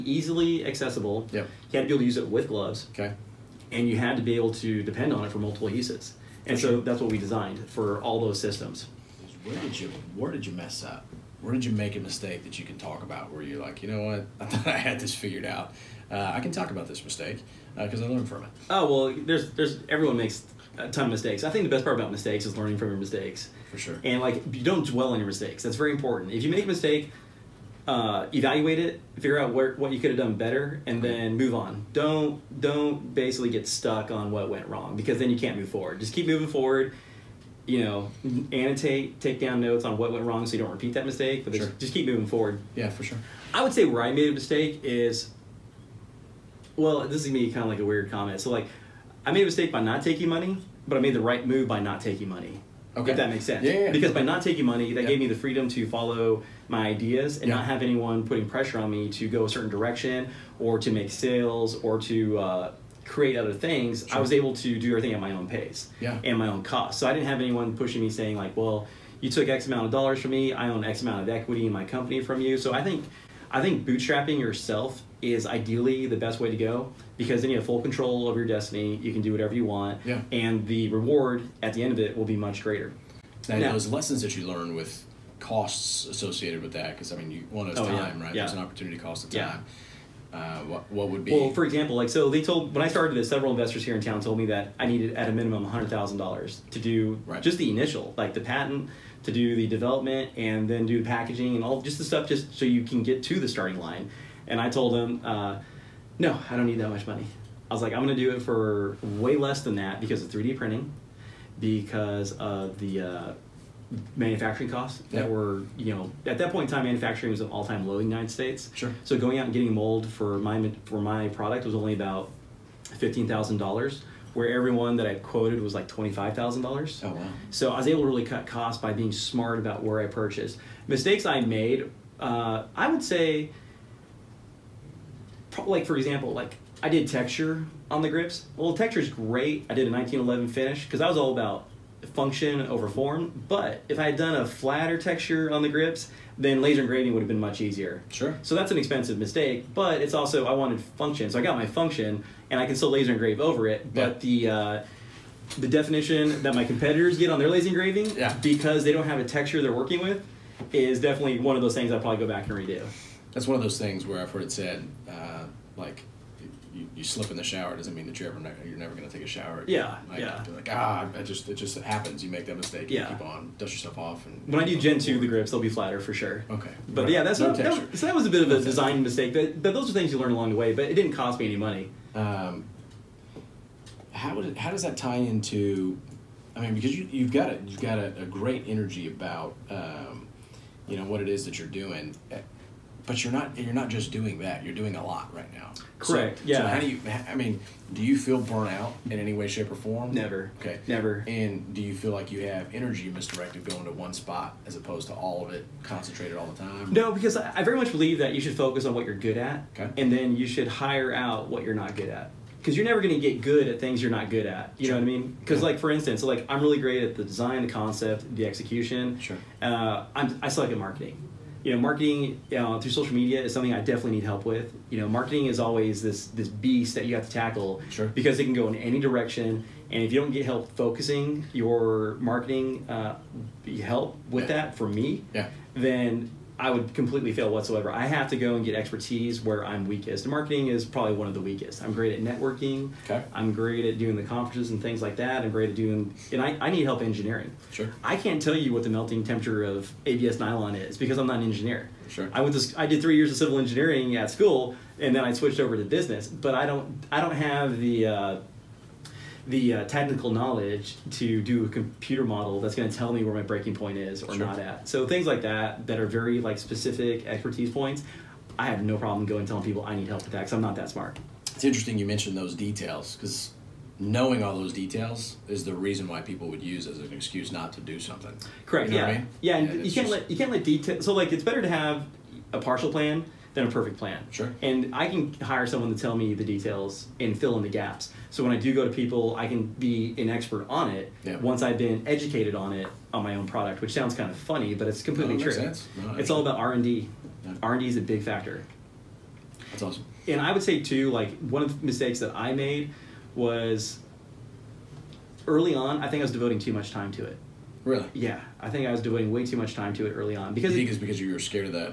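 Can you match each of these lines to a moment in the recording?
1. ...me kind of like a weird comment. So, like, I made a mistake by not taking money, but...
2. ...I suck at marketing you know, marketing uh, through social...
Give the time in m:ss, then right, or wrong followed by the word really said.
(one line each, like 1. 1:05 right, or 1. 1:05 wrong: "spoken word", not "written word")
1. 0:47 right
2. 3:40 right.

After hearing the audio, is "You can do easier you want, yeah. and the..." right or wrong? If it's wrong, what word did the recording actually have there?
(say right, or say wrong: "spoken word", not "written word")
wrong: "whatever", not "easier".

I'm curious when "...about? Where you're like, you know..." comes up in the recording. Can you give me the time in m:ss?
0:13.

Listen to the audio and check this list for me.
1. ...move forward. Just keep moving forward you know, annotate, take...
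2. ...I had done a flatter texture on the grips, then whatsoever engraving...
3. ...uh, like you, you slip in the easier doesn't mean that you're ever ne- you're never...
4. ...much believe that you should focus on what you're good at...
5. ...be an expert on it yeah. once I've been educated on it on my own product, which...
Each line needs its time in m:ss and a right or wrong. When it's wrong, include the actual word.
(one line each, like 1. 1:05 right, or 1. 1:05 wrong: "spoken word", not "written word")
1. 0:35 right
2. 2:23 wrong: "laser", not "whatsoever"
3. 2:45 wrong: "shower", not "easier"
4. 3:27 right
5. 4:49 right.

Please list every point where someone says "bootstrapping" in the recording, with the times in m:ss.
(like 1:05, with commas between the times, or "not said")
1:13.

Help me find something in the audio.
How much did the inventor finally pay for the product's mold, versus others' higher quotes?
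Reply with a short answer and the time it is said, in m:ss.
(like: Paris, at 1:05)
$15,000, at 2:02.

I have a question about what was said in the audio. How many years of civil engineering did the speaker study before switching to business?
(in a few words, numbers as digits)
3.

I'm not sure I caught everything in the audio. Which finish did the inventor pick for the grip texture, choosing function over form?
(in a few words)
1911 finish.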